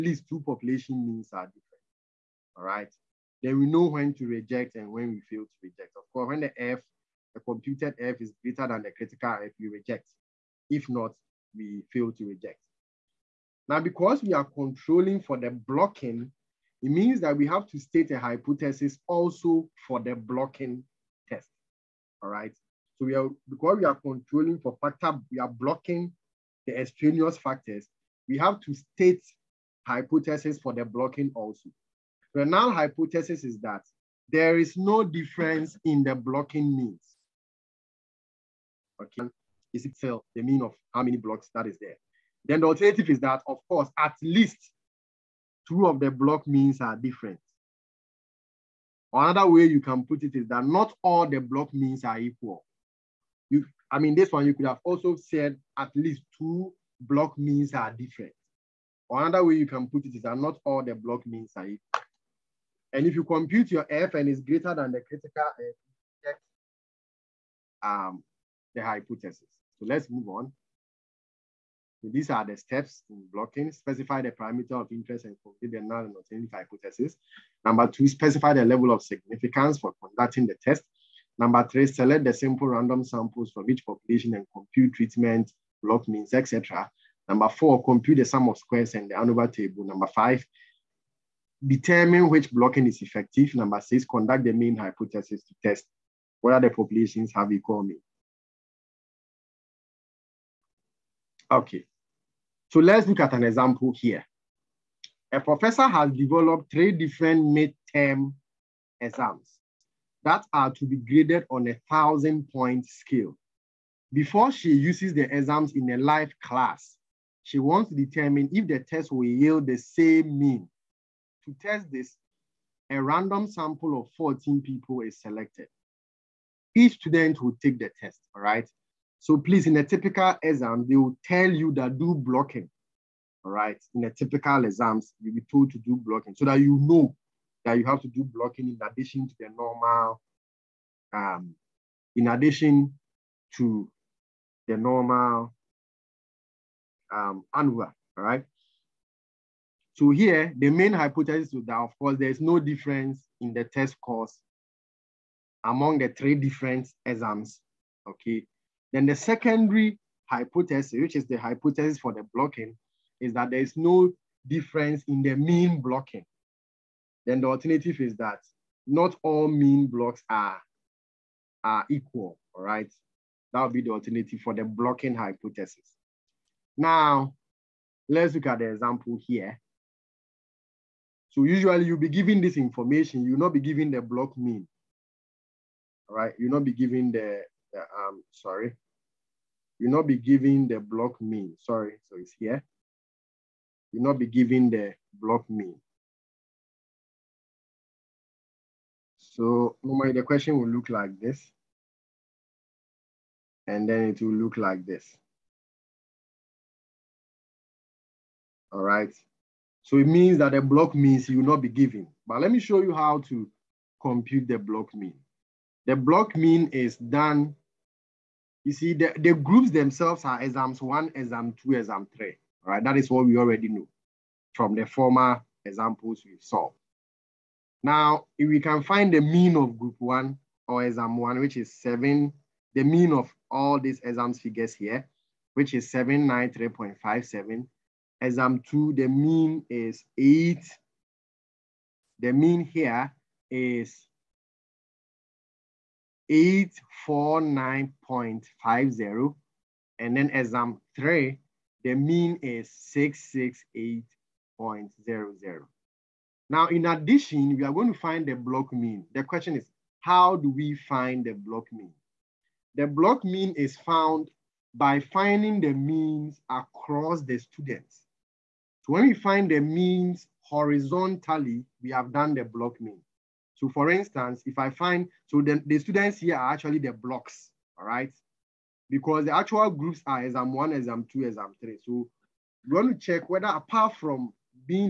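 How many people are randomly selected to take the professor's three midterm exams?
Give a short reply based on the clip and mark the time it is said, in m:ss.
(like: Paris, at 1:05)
14, at 2:04.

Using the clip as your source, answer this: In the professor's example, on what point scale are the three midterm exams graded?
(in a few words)
1000.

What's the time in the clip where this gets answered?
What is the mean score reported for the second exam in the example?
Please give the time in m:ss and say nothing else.
4:06.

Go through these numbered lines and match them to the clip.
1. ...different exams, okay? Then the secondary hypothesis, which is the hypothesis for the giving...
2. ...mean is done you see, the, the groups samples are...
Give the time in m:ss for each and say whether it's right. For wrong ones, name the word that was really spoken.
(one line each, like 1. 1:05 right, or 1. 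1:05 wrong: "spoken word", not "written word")
1. 2:36 wrong: "blocking", not "giving"
2. 3:36 wrong: "themselves", not "samples".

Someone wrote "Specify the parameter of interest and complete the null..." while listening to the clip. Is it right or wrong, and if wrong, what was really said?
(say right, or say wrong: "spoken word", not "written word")
right.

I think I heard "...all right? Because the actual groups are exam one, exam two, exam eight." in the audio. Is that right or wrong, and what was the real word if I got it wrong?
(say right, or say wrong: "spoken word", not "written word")
wrong: "three", not "eight".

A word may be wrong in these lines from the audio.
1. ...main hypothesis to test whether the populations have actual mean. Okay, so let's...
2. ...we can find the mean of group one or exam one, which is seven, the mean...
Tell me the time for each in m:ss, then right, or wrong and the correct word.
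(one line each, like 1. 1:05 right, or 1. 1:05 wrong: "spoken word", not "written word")
1. 1:34 wrong: "equal", not "actual"
2. 3:48 right.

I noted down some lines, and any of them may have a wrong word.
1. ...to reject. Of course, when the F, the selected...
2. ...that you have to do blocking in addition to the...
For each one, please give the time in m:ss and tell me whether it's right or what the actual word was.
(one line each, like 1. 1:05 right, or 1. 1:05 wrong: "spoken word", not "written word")
1. 0:05 wrong: "computed", not "selected"
2. 2:17 right.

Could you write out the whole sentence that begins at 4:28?
So when we find the means horizontally, we have done the block mean.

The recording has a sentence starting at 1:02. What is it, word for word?
And if you compute your f and it's greater than the critical f, um, the hypothesis.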